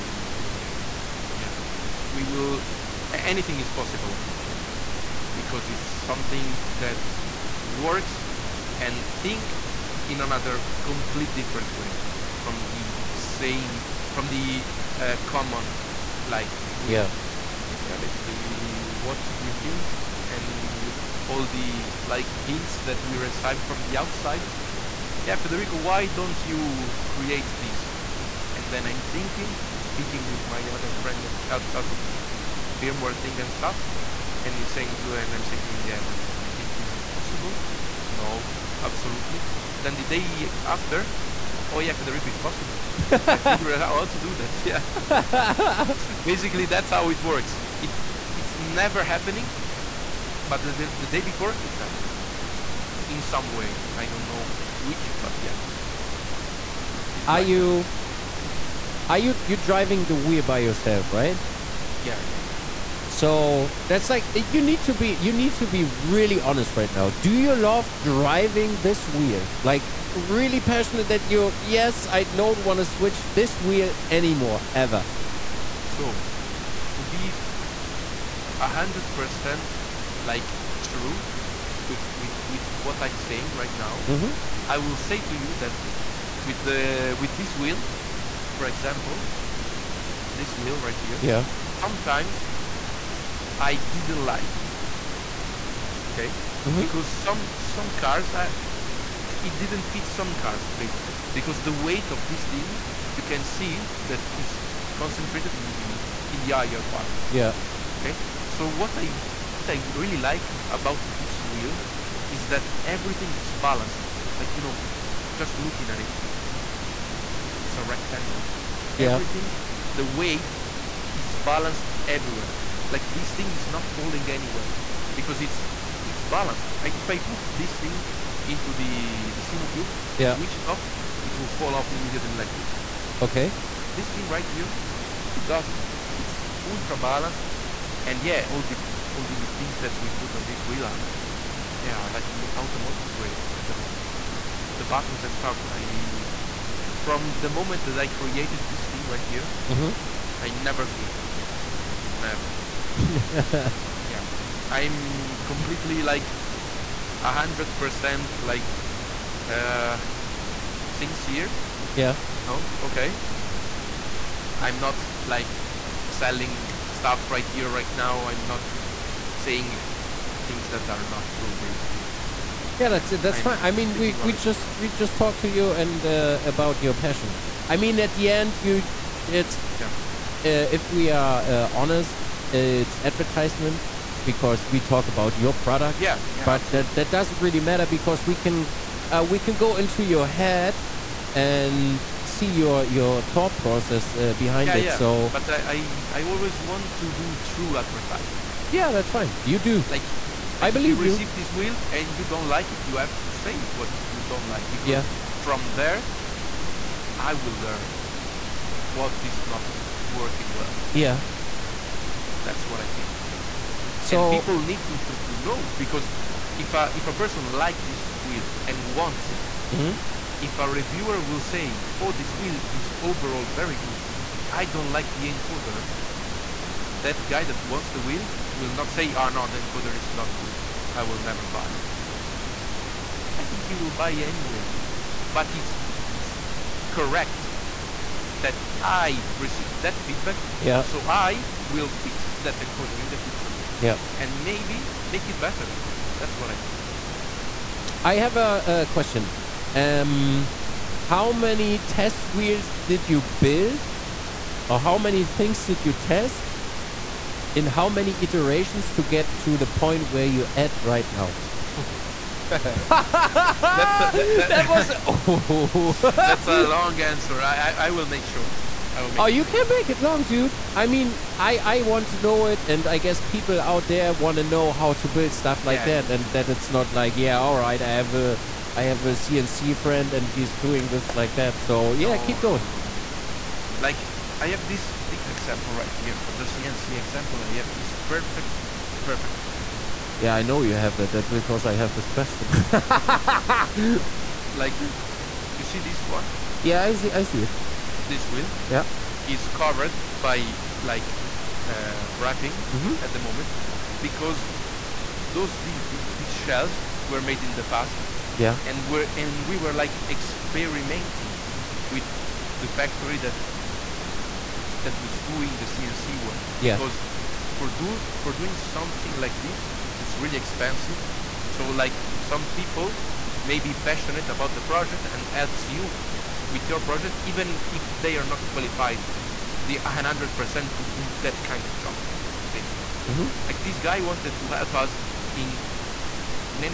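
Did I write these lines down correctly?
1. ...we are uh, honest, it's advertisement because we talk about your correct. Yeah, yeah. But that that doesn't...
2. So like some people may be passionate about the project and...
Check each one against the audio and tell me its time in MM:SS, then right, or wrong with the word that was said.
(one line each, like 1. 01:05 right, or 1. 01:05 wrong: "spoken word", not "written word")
1. 03:00 wrong: "product", not "correct"
2. 05:21 right.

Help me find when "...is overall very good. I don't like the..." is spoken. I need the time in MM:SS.
03:42.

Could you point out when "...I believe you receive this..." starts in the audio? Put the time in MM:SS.
03:20.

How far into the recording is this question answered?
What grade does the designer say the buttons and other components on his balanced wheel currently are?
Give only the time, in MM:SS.
02:22.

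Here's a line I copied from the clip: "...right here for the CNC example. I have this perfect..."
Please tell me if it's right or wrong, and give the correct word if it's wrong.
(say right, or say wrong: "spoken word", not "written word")
right.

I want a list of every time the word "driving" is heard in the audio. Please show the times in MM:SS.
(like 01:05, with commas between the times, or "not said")
00:59, 01:07.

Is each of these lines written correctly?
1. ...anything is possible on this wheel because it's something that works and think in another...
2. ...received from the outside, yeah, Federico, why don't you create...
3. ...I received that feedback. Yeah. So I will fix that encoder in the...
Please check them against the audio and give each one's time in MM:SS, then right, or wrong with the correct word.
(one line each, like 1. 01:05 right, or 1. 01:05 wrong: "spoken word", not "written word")
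1. 00:03 right
2. 00:23 right
3. 03:58 right.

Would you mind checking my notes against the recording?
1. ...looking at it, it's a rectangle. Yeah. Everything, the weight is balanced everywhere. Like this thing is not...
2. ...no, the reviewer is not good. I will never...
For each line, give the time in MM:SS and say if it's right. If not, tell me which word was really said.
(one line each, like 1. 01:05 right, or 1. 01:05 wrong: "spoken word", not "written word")
1. 01:55 right
2. 03:49 wrong: "encoder", not "reviewer".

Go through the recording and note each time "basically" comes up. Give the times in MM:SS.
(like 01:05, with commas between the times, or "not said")
00:17, 00:46, 01:40, 02:51, 03:33, 04:06, 05:32.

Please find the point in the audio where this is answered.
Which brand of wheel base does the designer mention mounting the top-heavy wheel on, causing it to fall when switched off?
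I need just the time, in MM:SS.
02:09.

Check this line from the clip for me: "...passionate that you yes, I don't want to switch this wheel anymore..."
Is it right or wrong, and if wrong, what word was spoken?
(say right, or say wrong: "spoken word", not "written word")
right.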